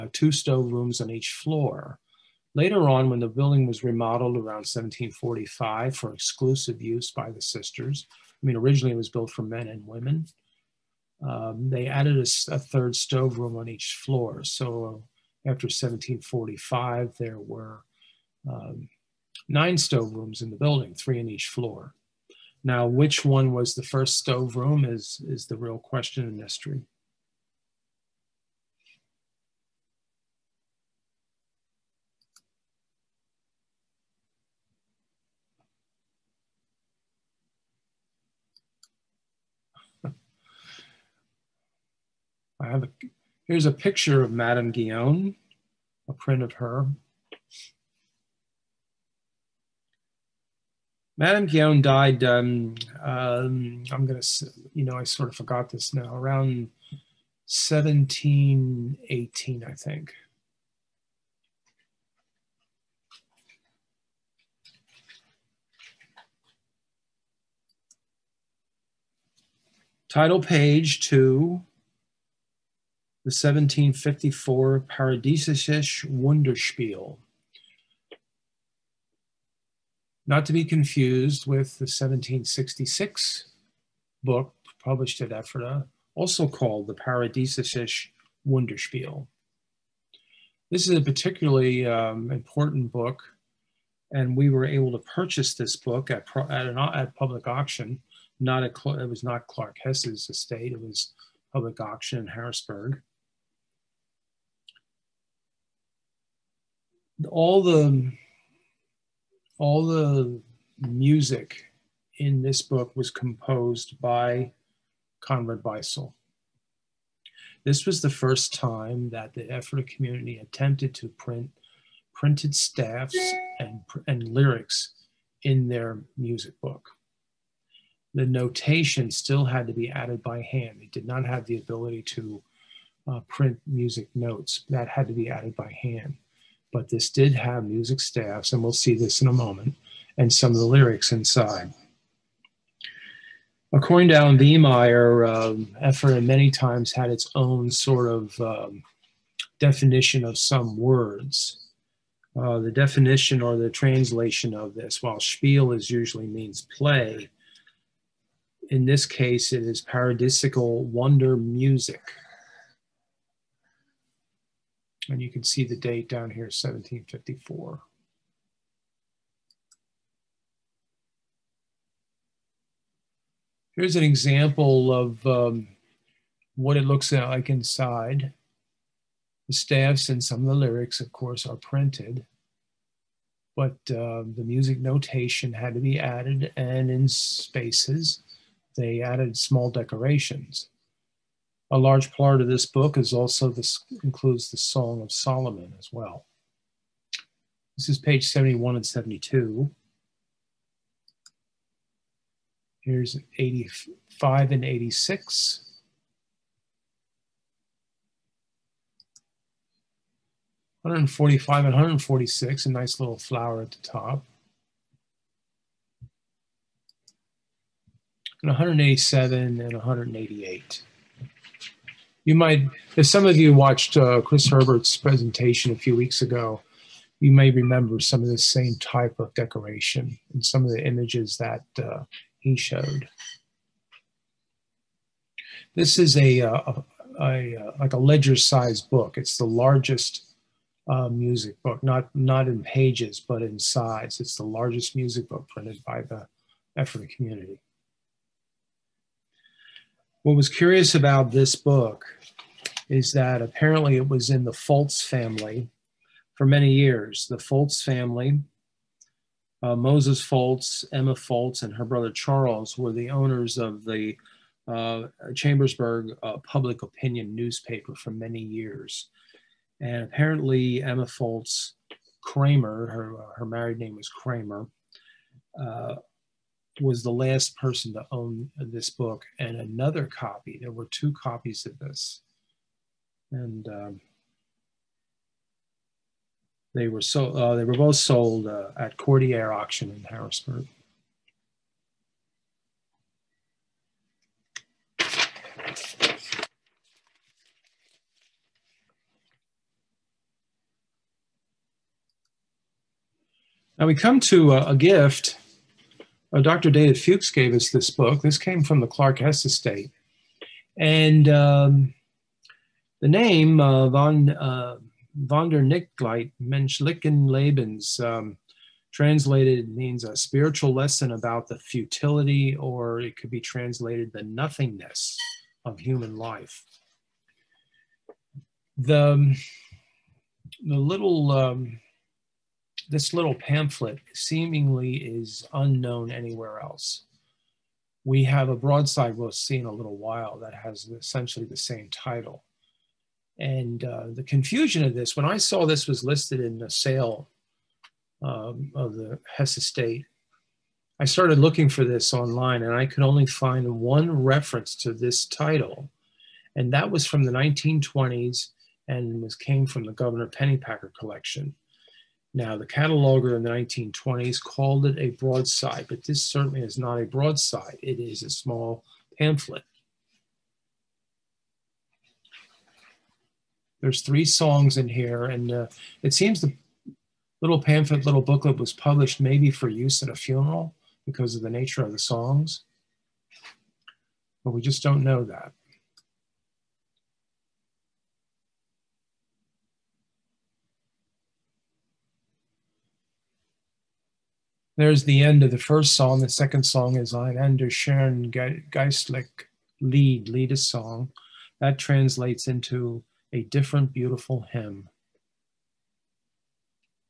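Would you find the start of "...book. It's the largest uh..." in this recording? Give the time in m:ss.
3:58.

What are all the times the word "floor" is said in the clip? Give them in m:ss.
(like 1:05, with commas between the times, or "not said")
0:01, 0:14, 0:21.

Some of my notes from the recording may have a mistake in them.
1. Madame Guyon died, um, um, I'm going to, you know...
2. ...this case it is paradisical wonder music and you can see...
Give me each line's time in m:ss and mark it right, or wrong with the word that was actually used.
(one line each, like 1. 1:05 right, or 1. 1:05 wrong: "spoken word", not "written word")
1. 0:51 right
2. 2:38 right.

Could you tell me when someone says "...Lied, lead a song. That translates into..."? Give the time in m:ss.
6:39.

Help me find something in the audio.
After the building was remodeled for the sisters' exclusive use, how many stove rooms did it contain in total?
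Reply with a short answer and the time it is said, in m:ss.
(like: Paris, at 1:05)
9, at 0:19.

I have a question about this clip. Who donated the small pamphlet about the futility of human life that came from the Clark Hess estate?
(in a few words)
Dr. David Fuchs.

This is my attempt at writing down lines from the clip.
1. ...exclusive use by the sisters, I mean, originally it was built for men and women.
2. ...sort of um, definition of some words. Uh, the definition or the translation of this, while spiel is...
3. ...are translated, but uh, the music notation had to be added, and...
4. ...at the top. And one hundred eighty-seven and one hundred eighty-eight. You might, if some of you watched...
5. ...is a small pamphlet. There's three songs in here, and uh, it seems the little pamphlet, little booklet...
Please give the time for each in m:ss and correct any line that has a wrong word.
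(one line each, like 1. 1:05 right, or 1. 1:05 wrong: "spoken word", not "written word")
1. 0:06 right
2. 2:27 right
3. 3:01 wrong: "printed", not "translated"
4. 3:33 right
5. 6:07 right.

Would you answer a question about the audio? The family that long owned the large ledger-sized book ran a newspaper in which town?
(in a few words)
Chambersburg.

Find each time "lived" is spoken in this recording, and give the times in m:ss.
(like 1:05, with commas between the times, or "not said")
not said.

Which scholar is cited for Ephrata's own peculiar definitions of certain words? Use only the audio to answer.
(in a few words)
Alan Wiemeyer.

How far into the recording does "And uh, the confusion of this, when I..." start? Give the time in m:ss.
5:43.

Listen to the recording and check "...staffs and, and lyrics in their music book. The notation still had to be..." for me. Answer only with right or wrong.
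right.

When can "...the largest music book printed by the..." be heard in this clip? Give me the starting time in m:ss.
4:04.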